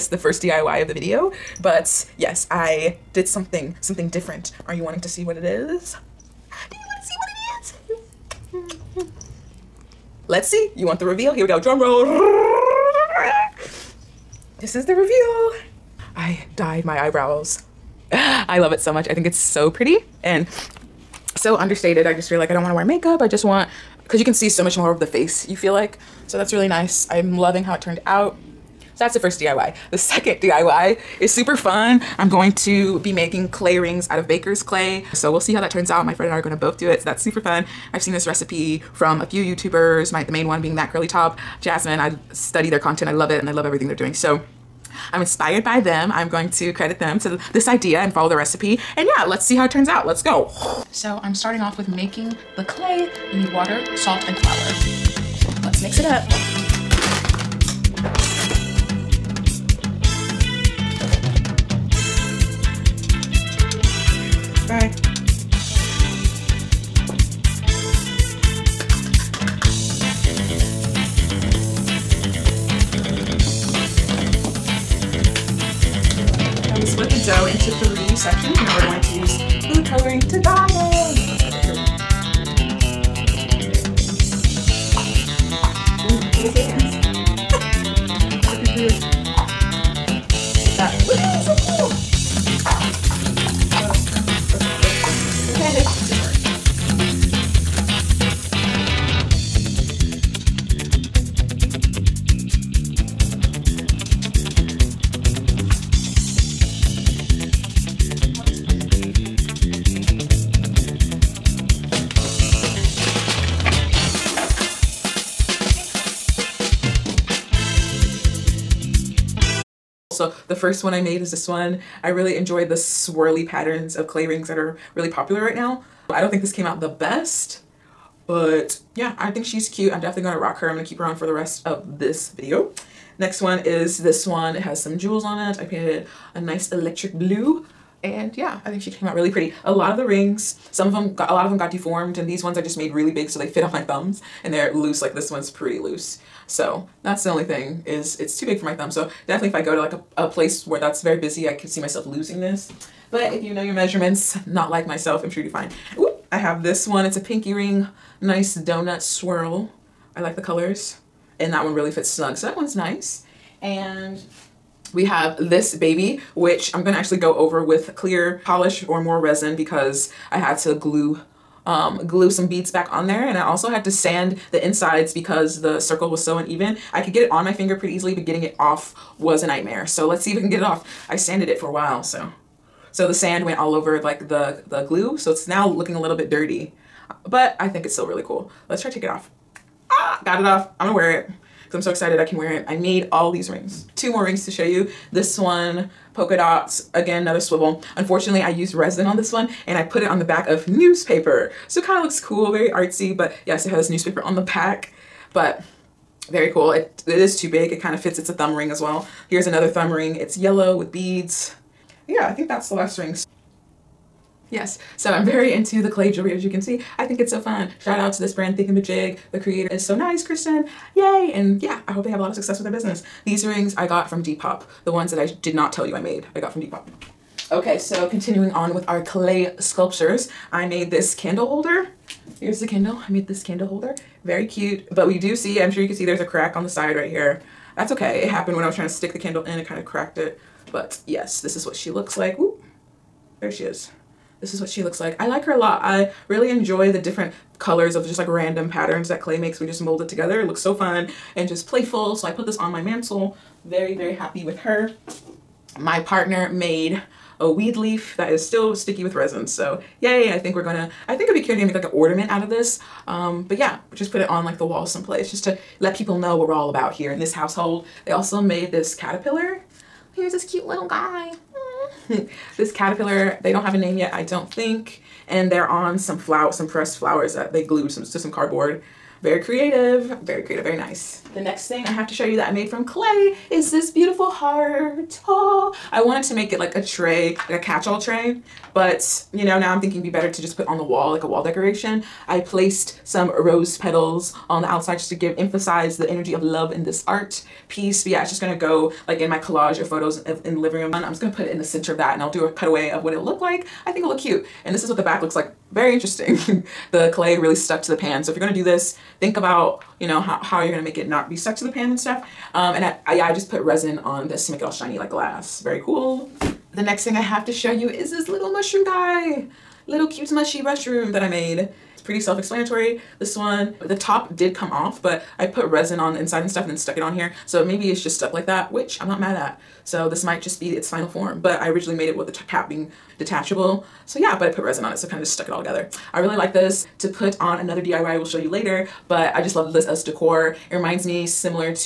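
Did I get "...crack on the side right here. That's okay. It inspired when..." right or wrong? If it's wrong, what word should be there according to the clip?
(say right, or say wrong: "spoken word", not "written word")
wrong: "happened", not "inspired".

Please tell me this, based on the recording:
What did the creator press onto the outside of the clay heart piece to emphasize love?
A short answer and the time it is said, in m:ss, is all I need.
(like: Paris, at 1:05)
Rose petals, at 4:53.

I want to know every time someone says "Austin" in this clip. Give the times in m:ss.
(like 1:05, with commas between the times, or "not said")
not said.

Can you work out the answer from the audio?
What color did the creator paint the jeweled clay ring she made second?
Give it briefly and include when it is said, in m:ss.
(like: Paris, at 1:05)
Electric blue, at 2:16.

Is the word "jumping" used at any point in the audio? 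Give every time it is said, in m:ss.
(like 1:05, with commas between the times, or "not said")
not said.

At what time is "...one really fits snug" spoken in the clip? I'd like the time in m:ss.
2:41.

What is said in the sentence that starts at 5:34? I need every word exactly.
So yeah, but I put resin on it, so kind of just stuck it all together.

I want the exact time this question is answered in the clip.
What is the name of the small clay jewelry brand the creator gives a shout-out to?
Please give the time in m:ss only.
3:38.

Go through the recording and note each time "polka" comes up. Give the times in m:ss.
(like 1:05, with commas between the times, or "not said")
3:16.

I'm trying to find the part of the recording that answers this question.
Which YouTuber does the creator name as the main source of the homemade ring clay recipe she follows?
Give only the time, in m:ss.
0:40.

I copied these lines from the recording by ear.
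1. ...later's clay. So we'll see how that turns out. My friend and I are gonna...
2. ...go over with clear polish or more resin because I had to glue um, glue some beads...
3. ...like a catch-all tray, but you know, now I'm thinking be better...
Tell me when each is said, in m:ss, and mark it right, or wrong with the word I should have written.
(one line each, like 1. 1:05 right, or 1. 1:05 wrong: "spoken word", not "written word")
1. 0:34 wrong: "baker", not "later"
2. 2:47 right
3. 4:47 right.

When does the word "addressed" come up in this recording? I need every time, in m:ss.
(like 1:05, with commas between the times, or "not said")
not said.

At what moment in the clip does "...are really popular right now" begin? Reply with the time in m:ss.
2:04.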